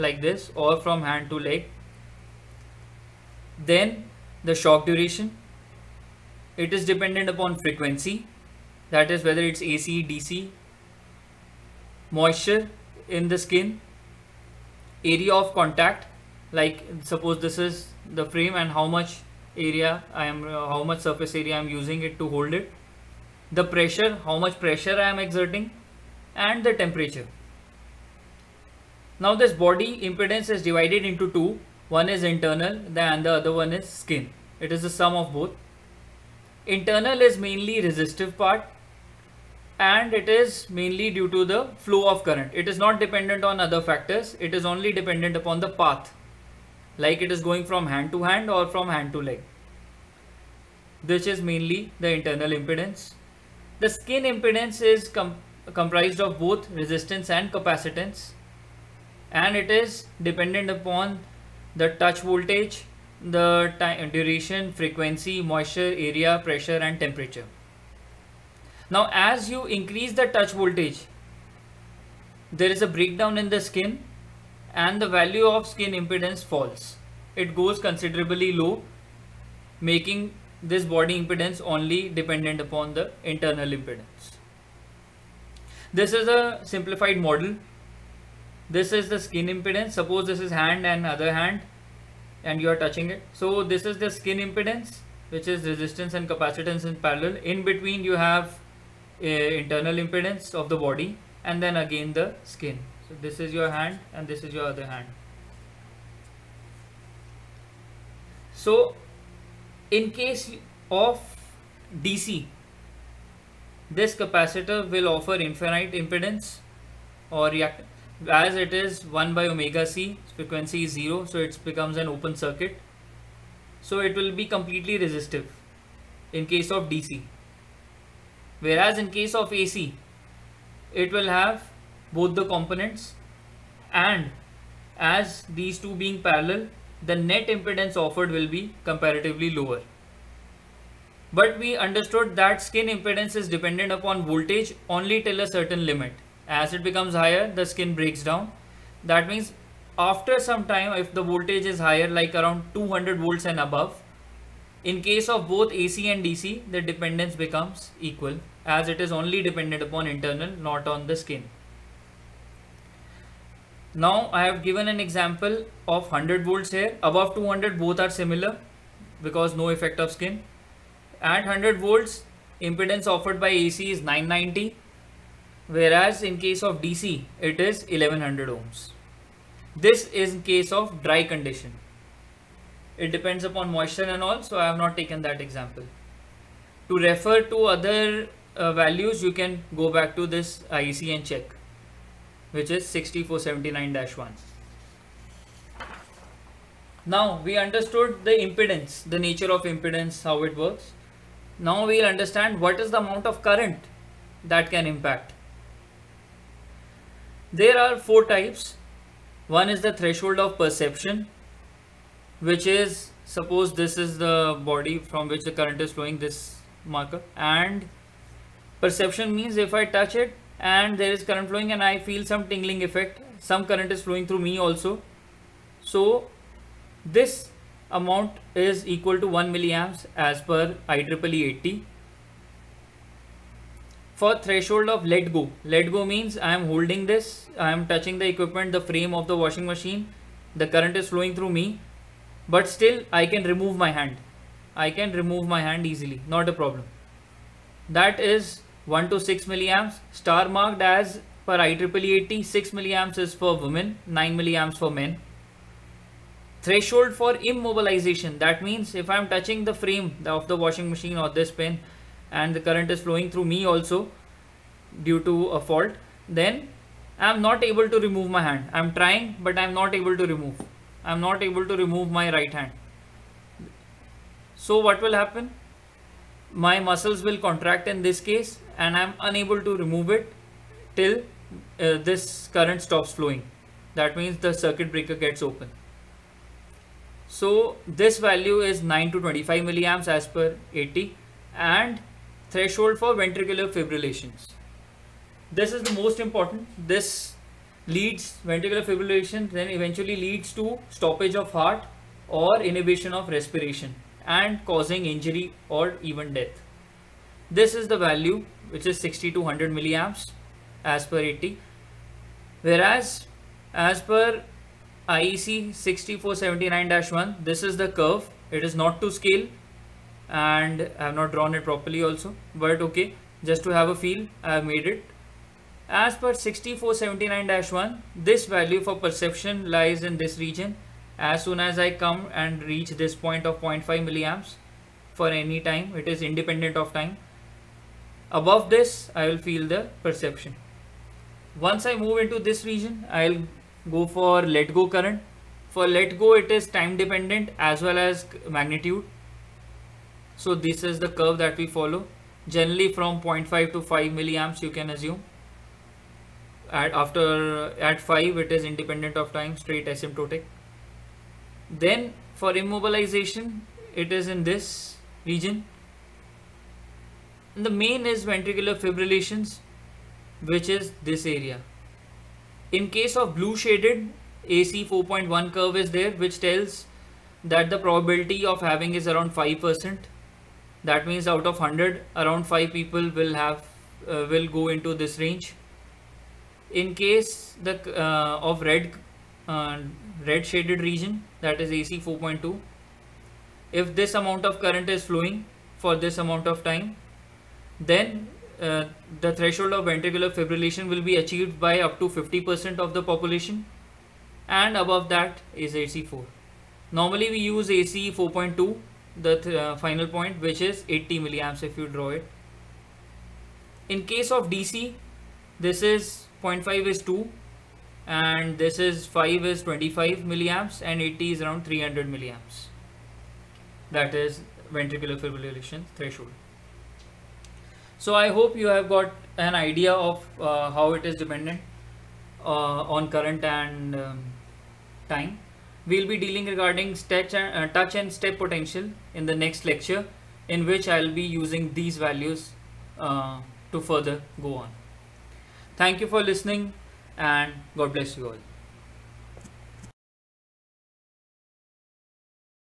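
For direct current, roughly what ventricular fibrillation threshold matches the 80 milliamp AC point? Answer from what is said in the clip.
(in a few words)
300 milliamps.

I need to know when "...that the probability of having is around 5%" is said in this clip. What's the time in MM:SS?
06:17.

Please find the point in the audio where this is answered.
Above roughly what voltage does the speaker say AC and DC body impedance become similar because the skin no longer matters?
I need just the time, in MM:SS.
02:32.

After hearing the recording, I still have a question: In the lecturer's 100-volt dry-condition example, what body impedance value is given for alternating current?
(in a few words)
990 ohms.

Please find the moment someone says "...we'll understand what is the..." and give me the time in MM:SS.
03:21.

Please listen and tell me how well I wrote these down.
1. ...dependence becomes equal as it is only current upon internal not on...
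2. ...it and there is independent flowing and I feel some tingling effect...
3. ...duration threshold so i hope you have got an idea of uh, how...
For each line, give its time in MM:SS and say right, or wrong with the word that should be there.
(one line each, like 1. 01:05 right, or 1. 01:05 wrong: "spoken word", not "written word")
1. 02:36 wrong: "dependent", not "current"
2. 03:40 wrong: "current", not "independent"
3. 07:05 wrong: "fibrillation", not "duration".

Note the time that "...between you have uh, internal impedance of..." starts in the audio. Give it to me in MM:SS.
01:37.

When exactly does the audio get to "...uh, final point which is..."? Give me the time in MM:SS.
06:49.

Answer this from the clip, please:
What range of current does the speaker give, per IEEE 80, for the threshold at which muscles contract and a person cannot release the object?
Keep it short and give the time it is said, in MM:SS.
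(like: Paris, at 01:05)
9 to 25 milliamps, at 04:48.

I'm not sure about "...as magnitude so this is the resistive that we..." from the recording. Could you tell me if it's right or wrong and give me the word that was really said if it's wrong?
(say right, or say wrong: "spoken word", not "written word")
wrong: "curve", not "resistive".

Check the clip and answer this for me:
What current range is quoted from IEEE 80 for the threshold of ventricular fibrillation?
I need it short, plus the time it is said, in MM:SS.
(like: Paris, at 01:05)
60 to 100 milliamps, at 05:08.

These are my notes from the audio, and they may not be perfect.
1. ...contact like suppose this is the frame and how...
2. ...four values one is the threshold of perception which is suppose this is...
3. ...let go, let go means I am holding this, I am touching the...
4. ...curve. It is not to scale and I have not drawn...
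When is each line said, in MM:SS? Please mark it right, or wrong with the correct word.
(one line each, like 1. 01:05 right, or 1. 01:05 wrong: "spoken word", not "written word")
1. 00:15 right
2. 03:27 wrong: "types", not "values"
3. 03:55 right
4. 05:17 right.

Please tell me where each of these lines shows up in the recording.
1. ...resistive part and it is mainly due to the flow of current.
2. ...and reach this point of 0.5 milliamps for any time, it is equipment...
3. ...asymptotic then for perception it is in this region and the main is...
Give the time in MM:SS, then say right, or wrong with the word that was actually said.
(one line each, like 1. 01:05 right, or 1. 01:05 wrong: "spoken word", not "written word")
1. 00:37 right
2. 05:32 wrong: "independent", not "equipment"
3. 05:59 wrong: "immobilization", not "perception".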